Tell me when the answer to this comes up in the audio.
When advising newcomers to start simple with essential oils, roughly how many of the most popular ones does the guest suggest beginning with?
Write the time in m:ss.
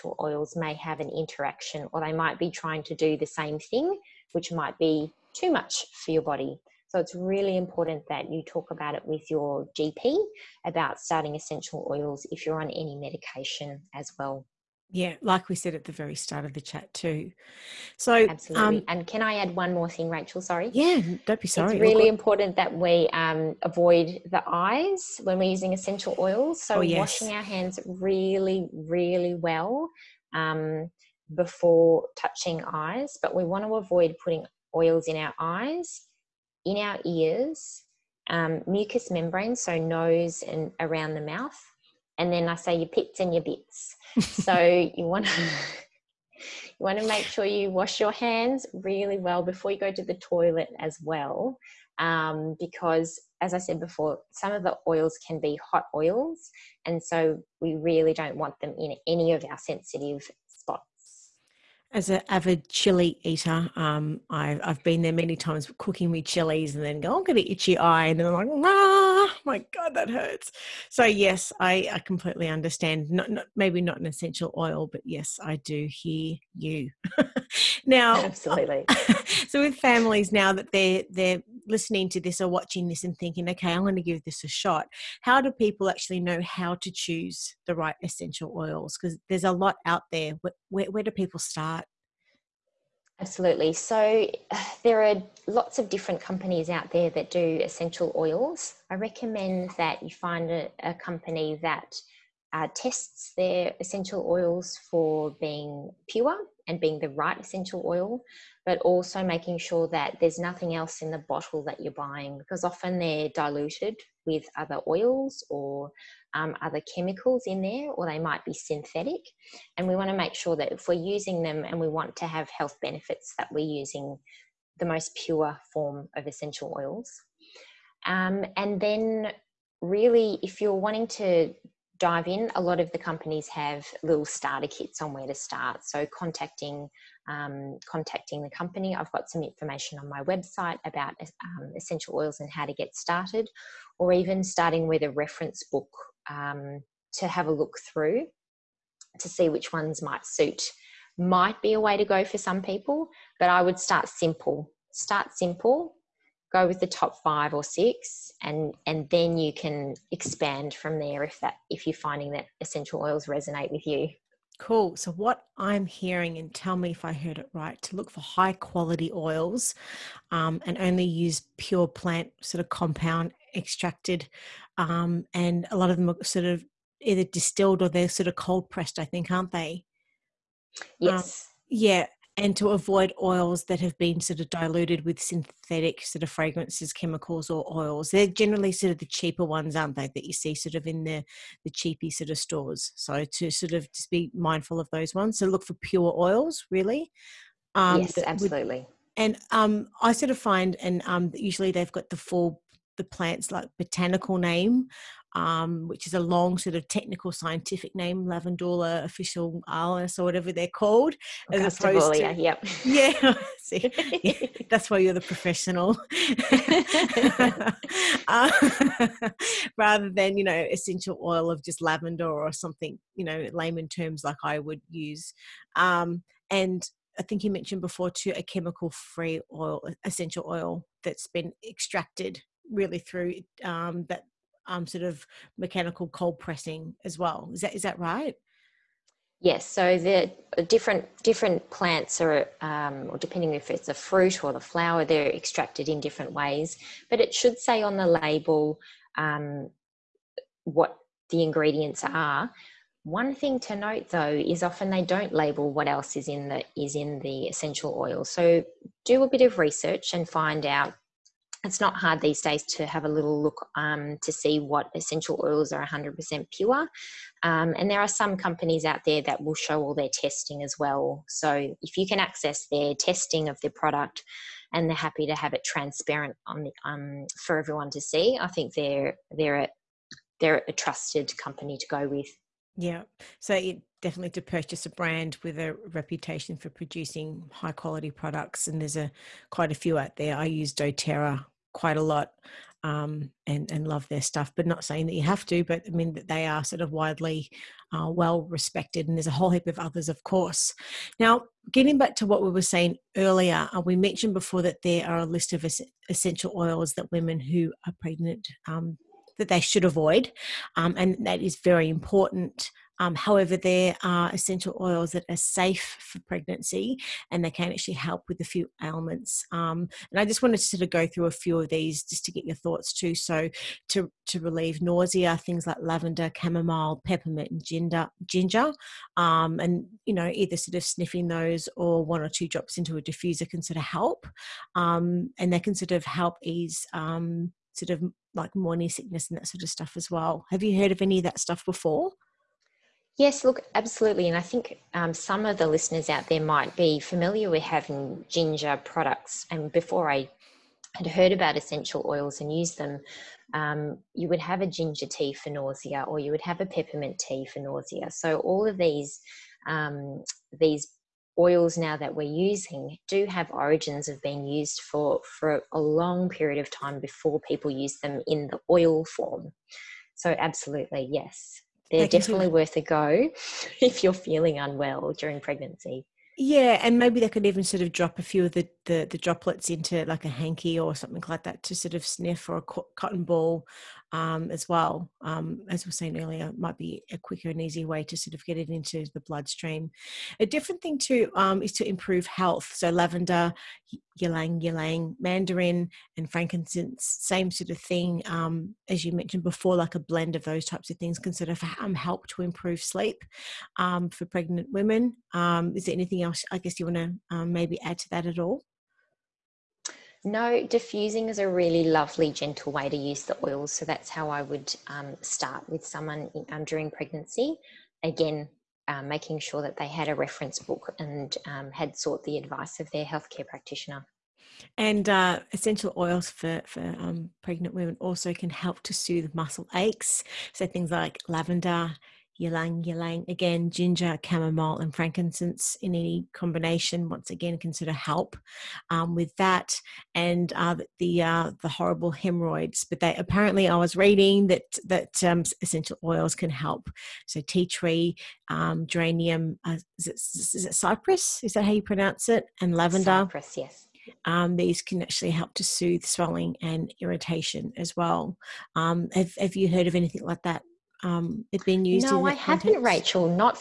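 2:37.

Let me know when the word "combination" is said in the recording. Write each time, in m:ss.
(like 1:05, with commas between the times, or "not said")
7:16.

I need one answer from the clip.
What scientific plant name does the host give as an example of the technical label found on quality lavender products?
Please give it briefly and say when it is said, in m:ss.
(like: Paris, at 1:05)
Lavandula officinalis, at 3:28.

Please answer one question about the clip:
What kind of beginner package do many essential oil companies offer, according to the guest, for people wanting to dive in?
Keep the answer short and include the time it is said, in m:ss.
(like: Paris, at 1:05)
starter kits, at 2:14.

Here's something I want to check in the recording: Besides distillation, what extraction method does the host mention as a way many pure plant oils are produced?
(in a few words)
cold pressed.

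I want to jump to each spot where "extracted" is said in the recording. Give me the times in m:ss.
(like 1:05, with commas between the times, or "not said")
2:53, 3:51, 4:05.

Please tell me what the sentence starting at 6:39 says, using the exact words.
Like a blend of those types of things can sort of help to improve sleep um, for pregnant women.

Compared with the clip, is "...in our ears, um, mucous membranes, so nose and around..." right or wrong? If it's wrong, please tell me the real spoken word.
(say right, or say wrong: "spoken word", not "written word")
right.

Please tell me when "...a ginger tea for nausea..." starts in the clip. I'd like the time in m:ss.
5:54.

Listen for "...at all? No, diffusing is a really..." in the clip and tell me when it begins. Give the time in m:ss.
6:48.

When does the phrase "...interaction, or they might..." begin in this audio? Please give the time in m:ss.
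0:01.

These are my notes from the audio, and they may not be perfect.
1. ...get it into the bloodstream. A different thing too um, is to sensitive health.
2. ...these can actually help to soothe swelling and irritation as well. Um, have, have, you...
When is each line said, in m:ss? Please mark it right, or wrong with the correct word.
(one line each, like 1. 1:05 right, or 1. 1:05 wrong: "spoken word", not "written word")
1. 6:28 wrong: "improve", not "sensitive"
2. 7:34 right.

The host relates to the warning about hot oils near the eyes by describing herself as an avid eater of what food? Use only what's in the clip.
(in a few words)
chili.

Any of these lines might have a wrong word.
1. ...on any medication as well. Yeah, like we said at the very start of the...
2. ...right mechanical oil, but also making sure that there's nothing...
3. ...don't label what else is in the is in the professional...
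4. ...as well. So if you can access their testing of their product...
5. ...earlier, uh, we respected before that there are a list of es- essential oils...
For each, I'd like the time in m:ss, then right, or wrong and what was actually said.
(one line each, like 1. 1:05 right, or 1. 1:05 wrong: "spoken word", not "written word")
1. 0:12 right
2. 1:47 wrong: "essential", not "mechanical"
3. 4:15 wrong: "essential", not "professional"
4. 4:30 right
5. 5:03 wrong: "mentioned", not "respected".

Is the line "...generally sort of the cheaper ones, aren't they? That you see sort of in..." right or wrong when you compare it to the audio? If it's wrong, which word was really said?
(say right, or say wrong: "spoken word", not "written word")
right.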